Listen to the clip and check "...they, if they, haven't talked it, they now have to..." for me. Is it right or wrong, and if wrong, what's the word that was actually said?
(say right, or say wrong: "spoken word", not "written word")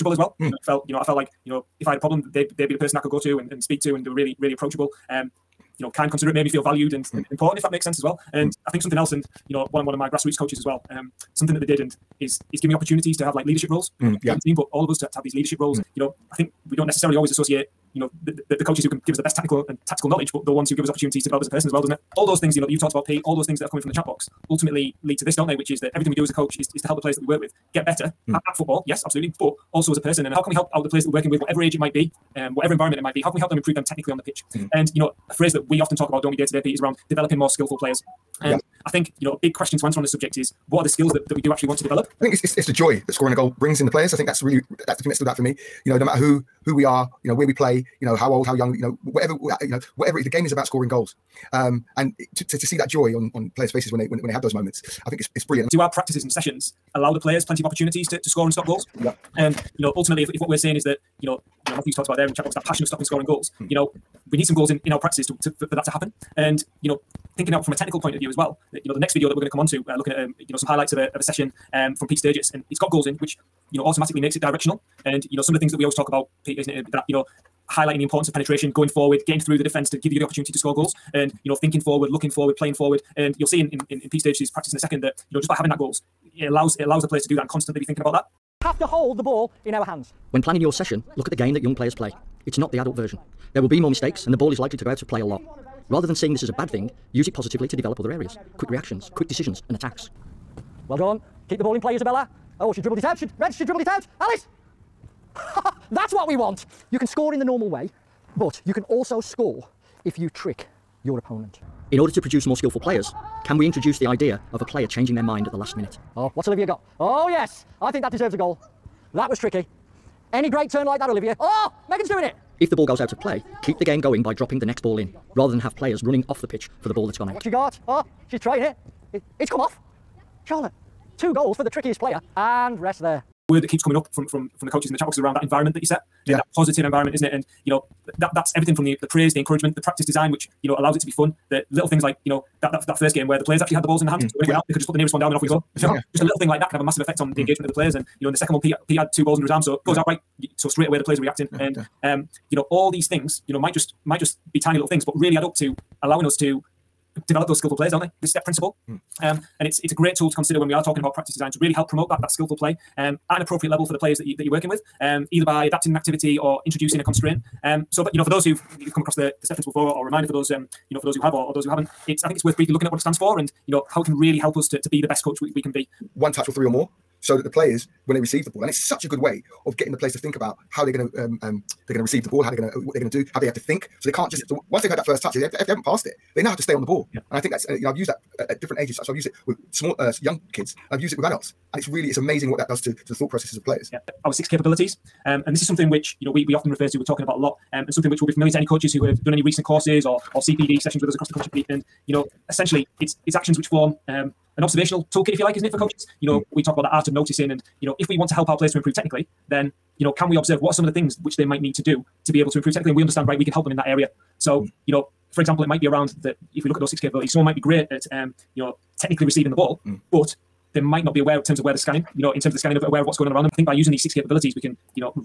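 wrong: "passed", not "talked".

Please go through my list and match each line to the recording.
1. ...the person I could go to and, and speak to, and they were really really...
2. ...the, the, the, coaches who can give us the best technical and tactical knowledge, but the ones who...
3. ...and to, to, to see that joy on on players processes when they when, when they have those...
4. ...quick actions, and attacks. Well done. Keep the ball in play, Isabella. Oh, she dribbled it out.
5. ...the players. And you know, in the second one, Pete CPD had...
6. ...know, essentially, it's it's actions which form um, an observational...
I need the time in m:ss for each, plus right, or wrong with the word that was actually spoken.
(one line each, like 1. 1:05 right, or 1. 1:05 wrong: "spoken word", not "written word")
1. 0:02 right
2. 0:18 right
3. 0:51 wrong: "faces", not "processes"
4. 1:39 wrong: "decisions", not "actions"
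5. 2:27 wrong: "Pete", not "CPD"
6. 3:22 right.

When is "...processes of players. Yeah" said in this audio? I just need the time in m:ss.
3:13.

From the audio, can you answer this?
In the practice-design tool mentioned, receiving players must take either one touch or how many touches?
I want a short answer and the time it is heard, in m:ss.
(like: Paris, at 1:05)
3 or more, at 2:56.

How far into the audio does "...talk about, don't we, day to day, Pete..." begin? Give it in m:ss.
0:35.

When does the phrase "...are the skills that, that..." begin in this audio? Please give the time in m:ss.
0:40.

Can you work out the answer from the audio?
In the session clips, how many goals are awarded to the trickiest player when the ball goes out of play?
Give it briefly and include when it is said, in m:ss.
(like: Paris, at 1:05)
2, at 2:11.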